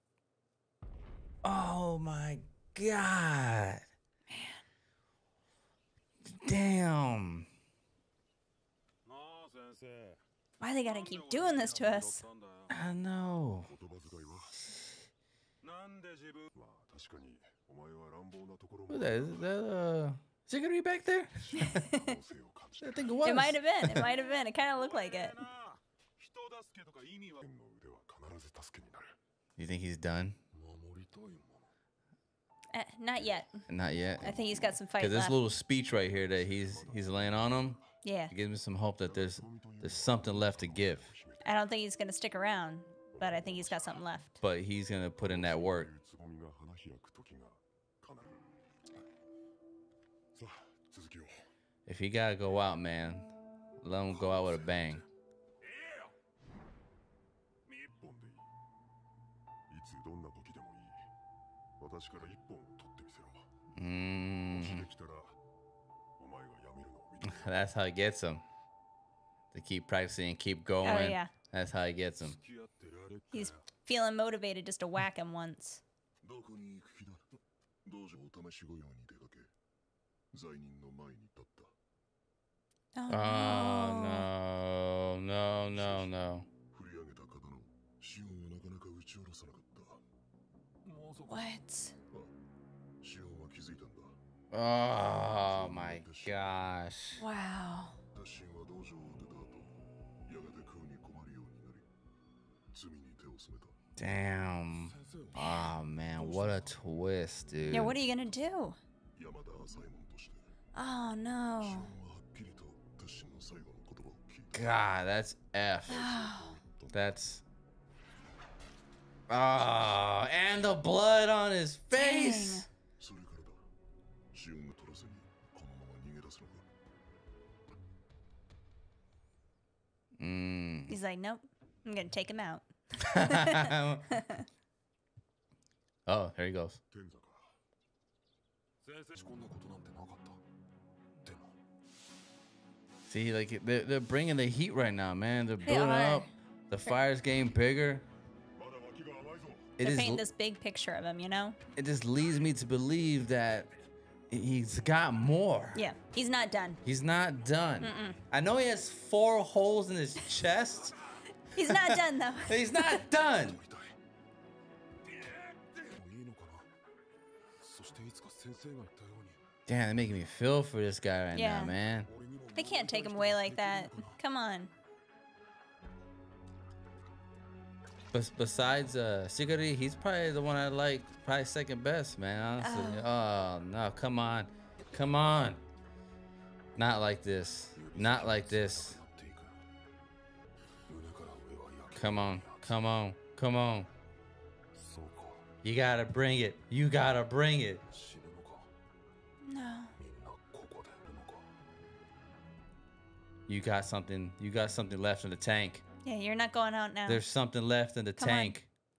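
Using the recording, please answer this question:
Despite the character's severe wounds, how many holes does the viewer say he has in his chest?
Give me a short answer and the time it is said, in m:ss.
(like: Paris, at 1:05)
4, at 2:38.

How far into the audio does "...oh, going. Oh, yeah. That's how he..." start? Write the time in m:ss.
1:10.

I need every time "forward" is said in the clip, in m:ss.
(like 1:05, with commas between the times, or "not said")
not said.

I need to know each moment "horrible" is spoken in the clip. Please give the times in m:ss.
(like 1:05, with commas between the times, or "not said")
not said.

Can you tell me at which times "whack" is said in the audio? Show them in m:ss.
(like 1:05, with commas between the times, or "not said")
1:14.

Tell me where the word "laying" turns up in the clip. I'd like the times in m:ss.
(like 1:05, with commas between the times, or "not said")
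0:37.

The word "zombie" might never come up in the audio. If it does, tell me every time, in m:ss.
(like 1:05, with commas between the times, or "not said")
not said.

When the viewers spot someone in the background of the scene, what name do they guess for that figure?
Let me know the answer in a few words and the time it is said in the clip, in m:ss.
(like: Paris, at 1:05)
Ziggery, at 0:20.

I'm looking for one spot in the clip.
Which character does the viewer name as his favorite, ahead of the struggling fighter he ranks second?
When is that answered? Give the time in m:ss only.
2:59.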